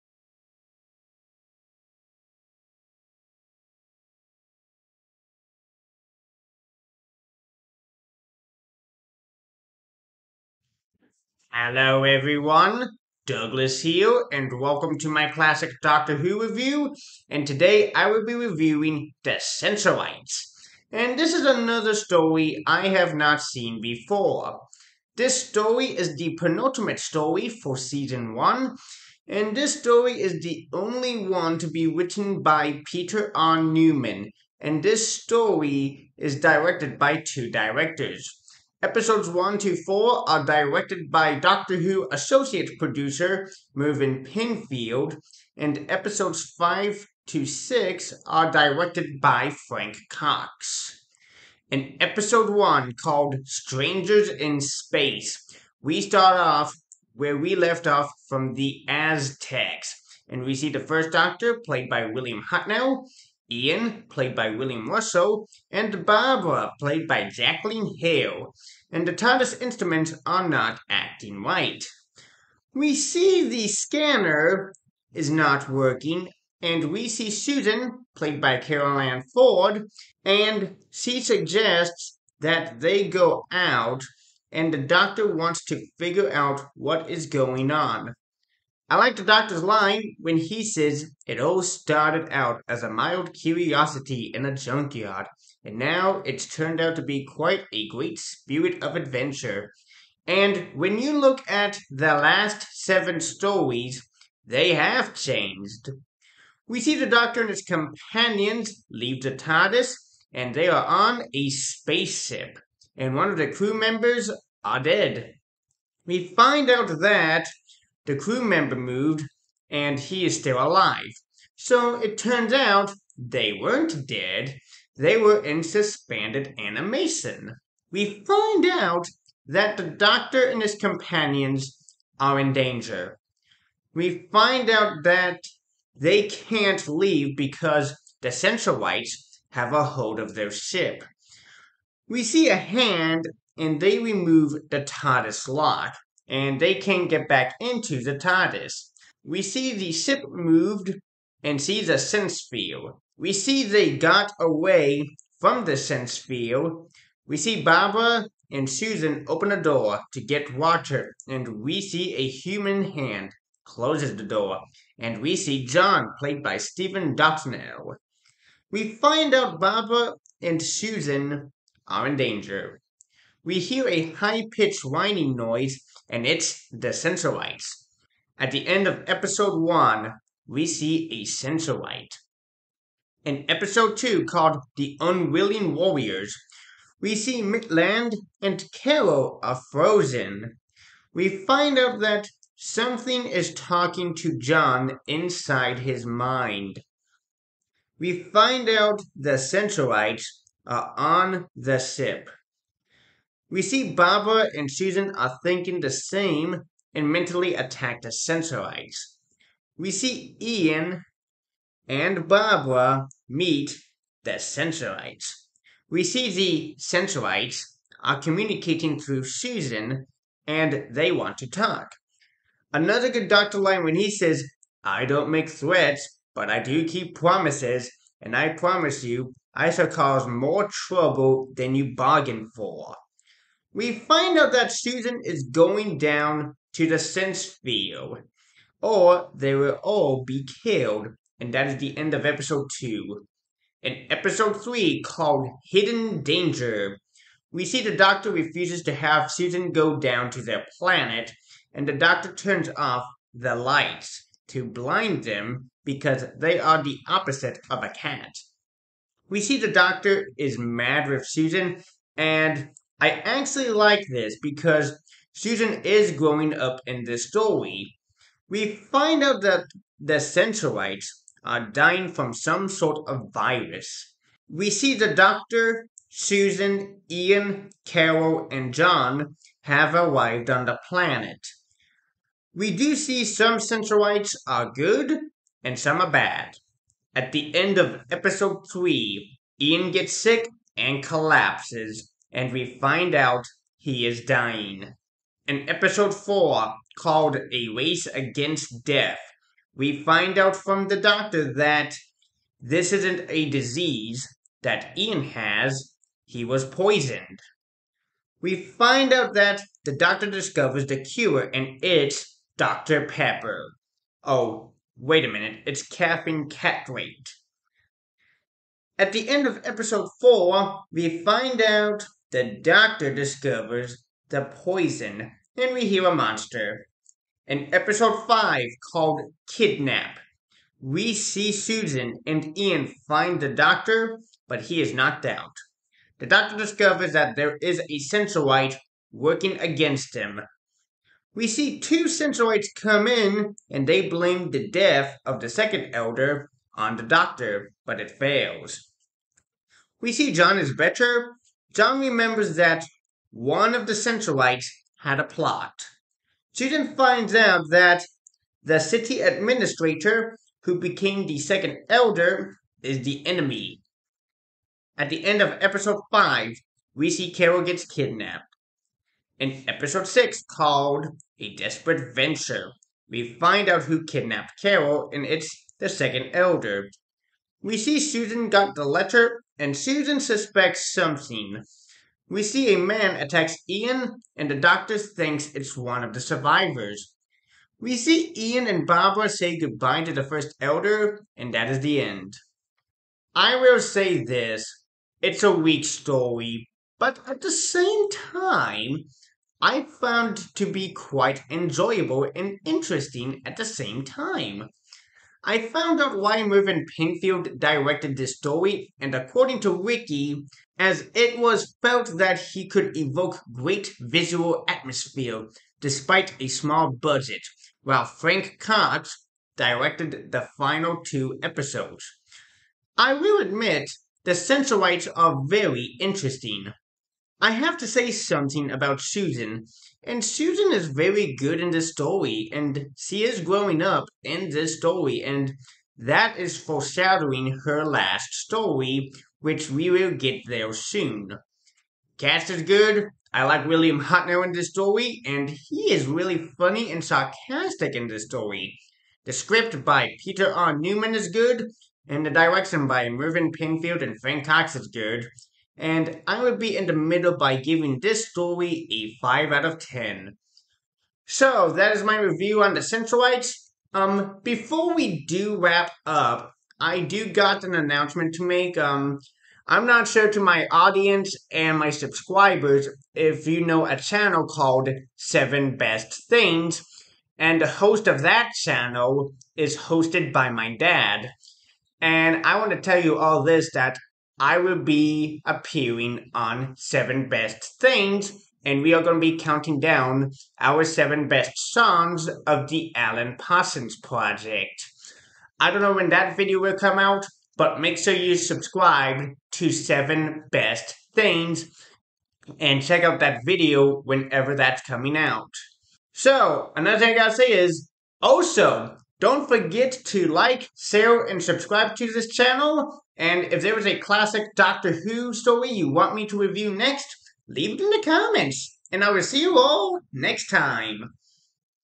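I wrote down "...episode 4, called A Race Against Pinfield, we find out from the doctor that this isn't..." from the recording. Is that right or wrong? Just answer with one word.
wrong.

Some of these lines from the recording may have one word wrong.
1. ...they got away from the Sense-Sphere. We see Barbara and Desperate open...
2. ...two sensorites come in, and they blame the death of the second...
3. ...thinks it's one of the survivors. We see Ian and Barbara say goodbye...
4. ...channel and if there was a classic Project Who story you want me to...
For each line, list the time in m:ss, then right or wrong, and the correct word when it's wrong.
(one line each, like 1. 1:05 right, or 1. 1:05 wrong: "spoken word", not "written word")
1. 2:33 wrong: "Susan", not "Desperate"
2. 5:41 right
3. 6:24 right
4. 8:32 wrong: "Doctor", not "Project".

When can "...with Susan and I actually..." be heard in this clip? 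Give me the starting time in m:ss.
4:21.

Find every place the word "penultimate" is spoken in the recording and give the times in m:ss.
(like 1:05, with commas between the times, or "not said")
0:26.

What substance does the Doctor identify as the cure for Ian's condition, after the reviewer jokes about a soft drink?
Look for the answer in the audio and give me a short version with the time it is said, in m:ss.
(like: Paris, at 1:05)
caffeine citrate, at 5:15.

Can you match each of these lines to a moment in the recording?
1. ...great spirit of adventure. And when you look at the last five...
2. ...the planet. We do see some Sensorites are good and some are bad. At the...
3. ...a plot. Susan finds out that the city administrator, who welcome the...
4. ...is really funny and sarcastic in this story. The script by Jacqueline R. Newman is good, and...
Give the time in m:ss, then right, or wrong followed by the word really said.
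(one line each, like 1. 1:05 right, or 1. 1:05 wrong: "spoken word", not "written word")
1. 1:37 wrong: "seven", not "five"
2. 4:40 right
3. 5:55 wrong: "became", not "welcome"
4. 7:25 wrong: "Peter", not "Jacqueline".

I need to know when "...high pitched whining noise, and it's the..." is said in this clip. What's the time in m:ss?
2:54.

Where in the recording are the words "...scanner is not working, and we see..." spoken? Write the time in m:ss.
1:13.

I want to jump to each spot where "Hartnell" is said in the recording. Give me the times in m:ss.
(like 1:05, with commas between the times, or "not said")
1:02, 7:24.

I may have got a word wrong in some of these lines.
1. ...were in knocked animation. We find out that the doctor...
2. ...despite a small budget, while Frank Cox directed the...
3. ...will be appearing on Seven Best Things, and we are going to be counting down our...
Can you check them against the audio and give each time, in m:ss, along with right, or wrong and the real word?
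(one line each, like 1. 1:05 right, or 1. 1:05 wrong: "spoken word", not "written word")
1. 2:05 wrong: "suspended", not "knocked"
2. 6:55 right
3. 8:04 right.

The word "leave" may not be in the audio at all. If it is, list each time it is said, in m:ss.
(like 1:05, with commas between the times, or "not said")
1:48, 2:16, 8:37.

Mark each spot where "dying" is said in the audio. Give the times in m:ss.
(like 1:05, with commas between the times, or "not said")
4:31, 4:54.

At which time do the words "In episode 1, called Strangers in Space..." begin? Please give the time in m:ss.
0:51.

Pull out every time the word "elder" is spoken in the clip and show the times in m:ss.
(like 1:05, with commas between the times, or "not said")
5:45, 6:01, 6:16, 6:30.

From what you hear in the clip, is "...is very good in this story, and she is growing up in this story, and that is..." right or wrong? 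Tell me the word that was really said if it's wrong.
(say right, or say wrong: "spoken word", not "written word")
right.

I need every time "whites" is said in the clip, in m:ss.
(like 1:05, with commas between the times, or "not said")
2:18.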